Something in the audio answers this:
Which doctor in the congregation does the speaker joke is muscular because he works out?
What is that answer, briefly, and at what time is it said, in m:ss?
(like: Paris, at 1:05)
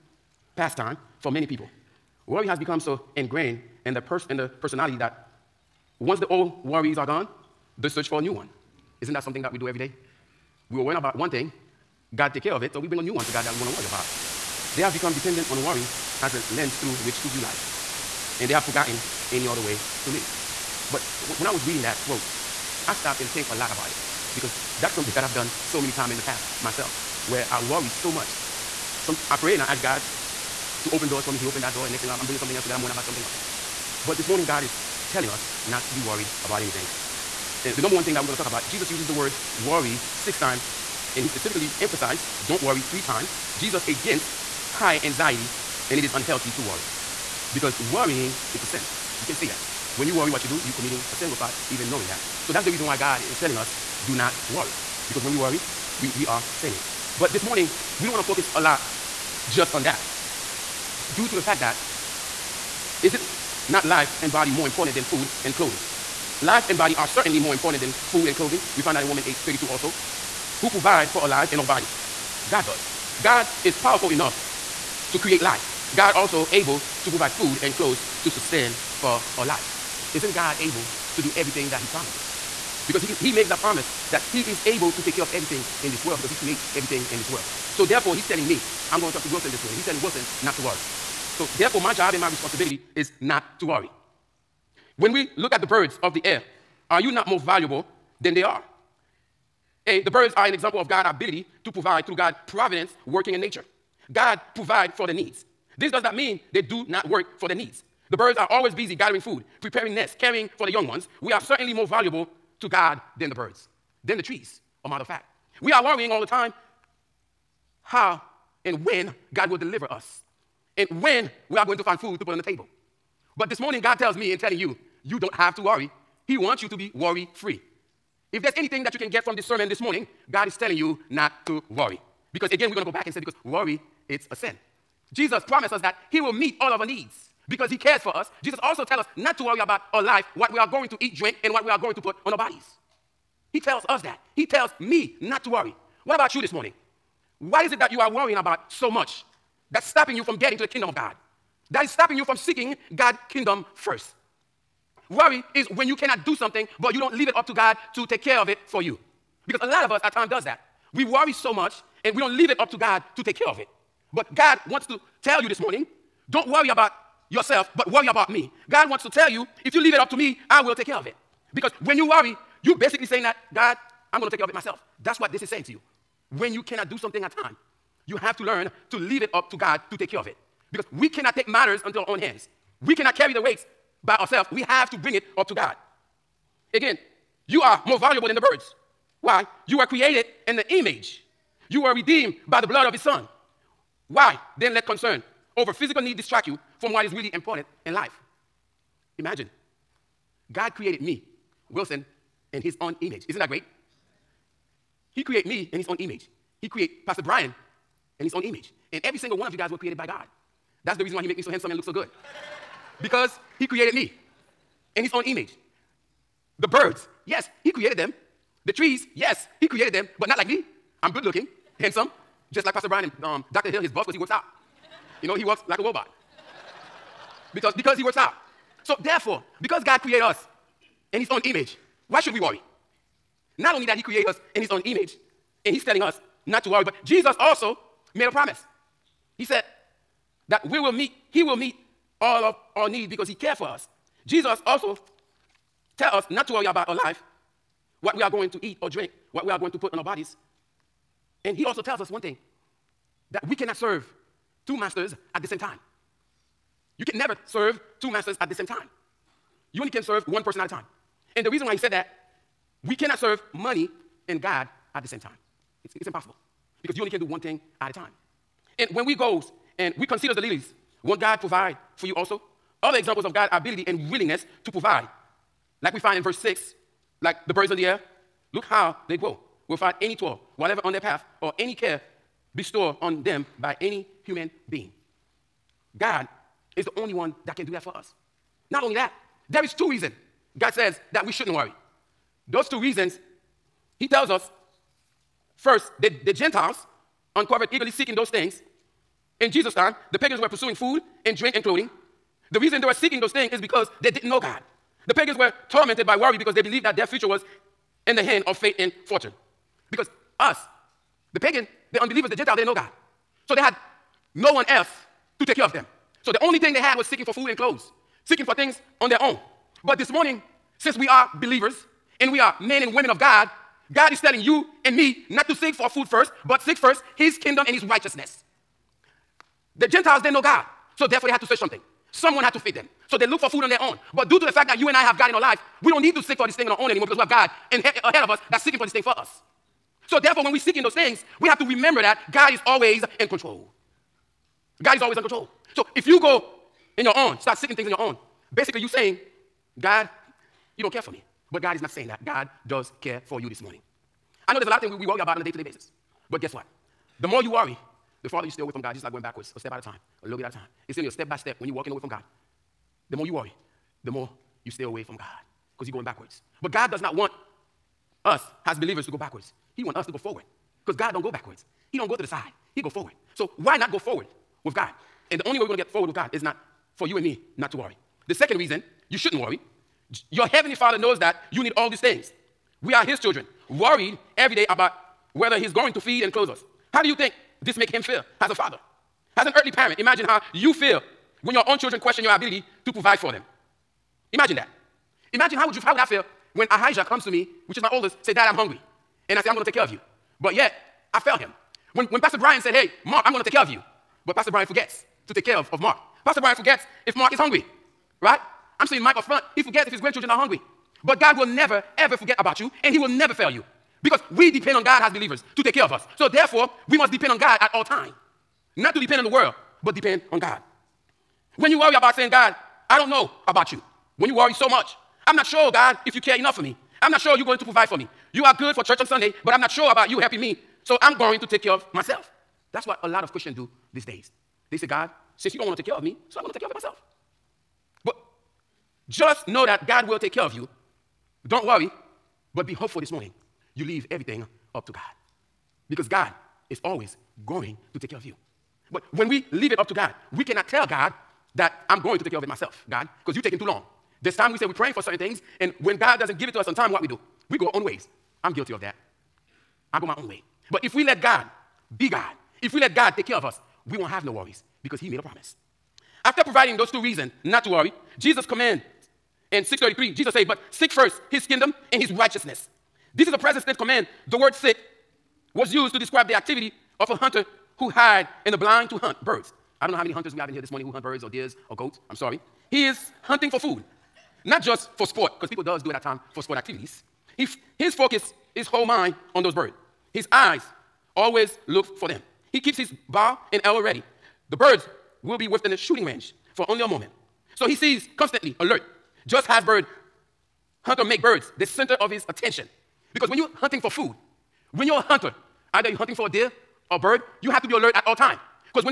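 Dr. Hill, at 3:43.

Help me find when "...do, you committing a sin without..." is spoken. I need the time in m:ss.
0:50.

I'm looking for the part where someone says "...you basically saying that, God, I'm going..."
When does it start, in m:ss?
2:52.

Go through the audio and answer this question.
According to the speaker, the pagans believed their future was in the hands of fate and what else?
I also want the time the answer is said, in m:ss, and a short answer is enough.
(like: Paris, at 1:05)
fortune, at 5:09.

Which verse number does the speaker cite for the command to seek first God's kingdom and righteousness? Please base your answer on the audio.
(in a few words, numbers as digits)
633.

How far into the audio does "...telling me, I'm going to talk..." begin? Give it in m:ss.
1:28.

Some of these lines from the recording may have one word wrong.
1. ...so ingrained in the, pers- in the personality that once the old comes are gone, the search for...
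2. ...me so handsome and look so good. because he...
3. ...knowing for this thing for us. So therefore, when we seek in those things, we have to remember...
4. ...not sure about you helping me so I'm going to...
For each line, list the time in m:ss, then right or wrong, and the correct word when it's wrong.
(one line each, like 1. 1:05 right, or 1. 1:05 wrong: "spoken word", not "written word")
1. 0:02 wrong: "worries", not "comes"
2. 3:31 right
3. 5:38 wrong: "seeking", not "knowing"
4. 7:09 right.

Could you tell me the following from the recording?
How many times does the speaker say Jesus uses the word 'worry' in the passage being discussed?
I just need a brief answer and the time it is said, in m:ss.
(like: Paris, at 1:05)
6, at 0:40.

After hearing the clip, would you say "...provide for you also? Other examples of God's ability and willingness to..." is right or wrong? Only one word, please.
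right.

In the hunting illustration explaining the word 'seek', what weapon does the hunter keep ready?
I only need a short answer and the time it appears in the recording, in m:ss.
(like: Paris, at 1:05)
bow and arrow, at 8:13.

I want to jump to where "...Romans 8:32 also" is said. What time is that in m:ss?
1:09.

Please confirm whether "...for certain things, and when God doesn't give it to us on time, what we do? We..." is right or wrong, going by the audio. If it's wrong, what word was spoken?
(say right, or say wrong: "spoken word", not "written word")
right.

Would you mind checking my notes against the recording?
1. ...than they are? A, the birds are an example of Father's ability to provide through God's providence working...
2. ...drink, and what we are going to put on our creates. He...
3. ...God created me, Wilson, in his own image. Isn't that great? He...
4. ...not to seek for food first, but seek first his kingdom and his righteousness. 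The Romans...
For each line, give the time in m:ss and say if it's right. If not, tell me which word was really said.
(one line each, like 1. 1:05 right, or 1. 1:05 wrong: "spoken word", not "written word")
1. 1:38 wrong: "God", not "Father"
2. 2:21 wrong: "bodies", not "creates"
3. 3:20 right
4. 5:25 wrong: "Gentiles", not "Romans".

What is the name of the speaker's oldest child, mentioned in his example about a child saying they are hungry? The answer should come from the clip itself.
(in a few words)
Ahijah.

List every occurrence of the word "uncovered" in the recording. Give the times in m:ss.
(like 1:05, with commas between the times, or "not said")
4:57.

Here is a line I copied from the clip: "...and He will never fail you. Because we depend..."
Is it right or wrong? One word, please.
right.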